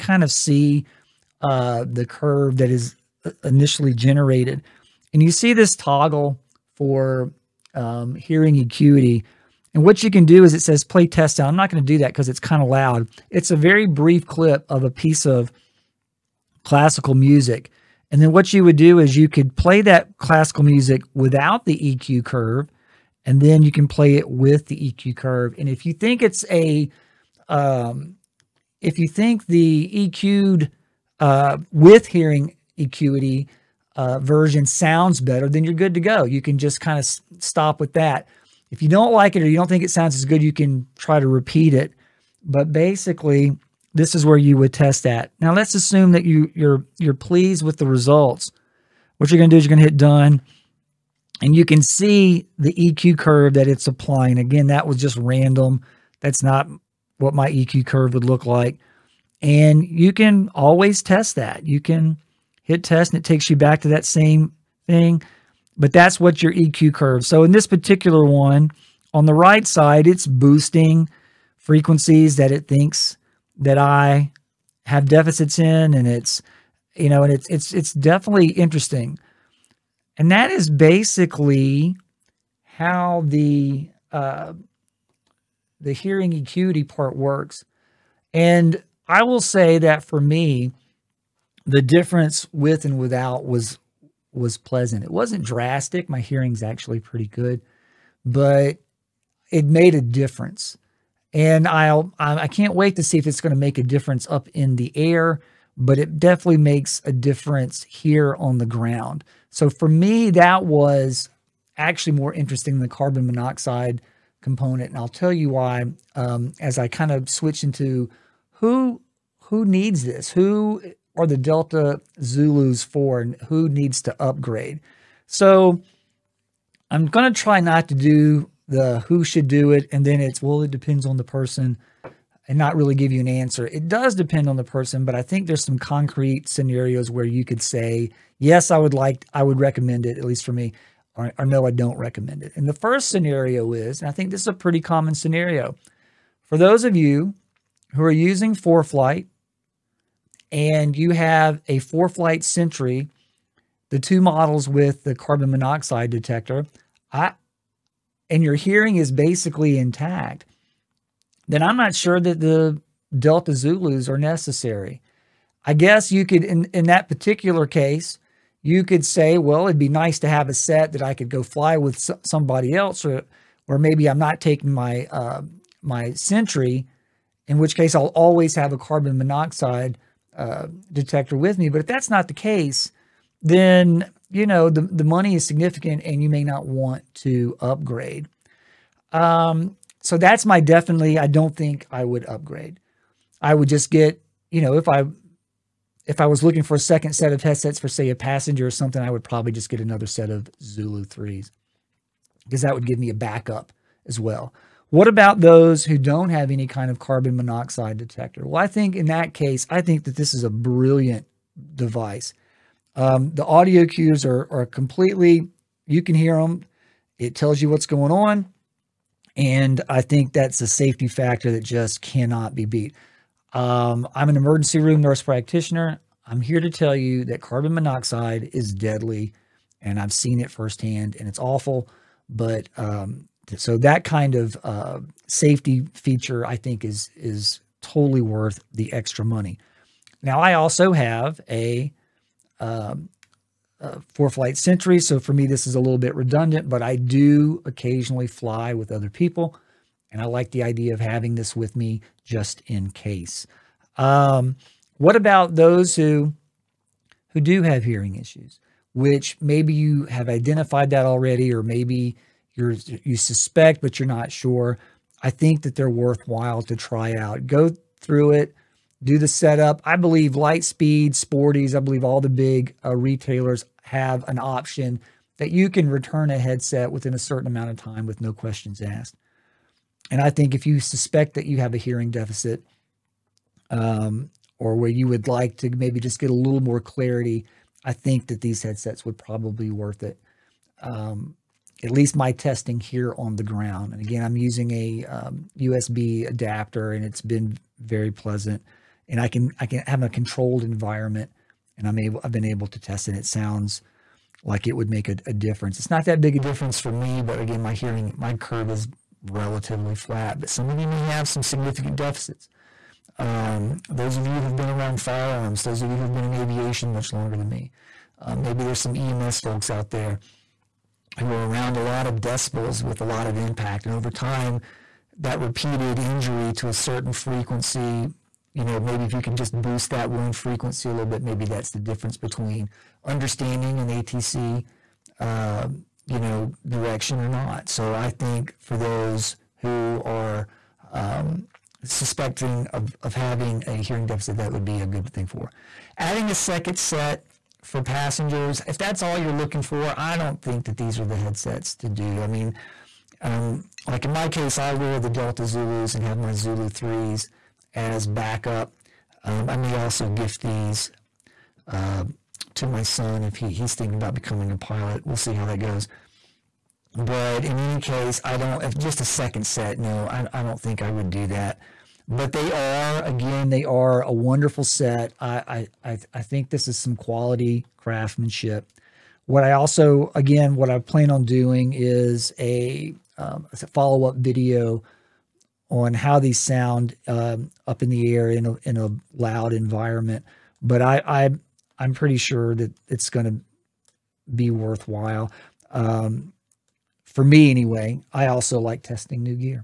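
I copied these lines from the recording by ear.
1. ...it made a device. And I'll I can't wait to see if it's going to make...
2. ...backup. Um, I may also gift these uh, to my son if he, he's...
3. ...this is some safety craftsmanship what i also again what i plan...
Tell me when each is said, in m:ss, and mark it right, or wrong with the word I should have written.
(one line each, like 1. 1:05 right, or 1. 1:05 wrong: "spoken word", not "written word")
1. 1:39 wrong: "difference", not "device"
2. 5:58 right
3. 6:16 wrong: "quality", not "safety".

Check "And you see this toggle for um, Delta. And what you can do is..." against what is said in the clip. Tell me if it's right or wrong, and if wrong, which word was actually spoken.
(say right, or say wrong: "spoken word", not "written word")
wrong: "HearingEQity", not "Delta".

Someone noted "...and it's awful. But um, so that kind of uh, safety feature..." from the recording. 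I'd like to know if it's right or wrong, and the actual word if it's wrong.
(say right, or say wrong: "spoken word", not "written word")
right.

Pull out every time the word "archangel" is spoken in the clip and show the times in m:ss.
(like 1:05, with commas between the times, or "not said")
not said.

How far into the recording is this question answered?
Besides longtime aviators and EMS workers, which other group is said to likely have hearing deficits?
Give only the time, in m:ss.
5:15.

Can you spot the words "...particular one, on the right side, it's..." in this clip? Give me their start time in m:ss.
1:07.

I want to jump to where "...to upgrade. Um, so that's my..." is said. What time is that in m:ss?
3:07.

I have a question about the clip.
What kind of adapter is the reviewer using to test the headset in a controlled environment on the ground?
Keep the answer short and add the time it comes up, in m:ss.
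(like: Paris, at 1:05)
USB adapter, at 4:55.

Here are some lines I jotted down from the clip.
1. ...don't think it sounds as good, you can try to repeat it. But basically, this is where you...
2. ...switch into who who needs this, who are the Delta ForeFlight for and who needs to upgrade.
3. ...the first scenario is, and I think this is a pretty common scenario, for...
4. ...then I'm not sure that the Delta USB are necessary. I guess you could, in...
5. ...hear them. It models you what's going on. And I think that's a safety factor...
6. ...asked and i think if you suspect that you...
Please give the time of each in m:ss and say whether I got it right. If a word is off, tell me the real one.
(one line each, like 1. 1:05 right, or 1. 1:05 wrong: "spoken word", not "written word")
1. 0:39 right
2. 1:57 wrong: "Zulus", not "ForeFlight"
3. 2:22 right
4. 2:41 wrong: "Zulus", not "USB"
5. 3:36 wrong: "tells", not "models"
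6. 4:38 right.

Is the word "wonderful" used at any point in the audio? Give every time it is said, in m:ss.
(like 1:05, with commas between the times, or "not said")
6:14.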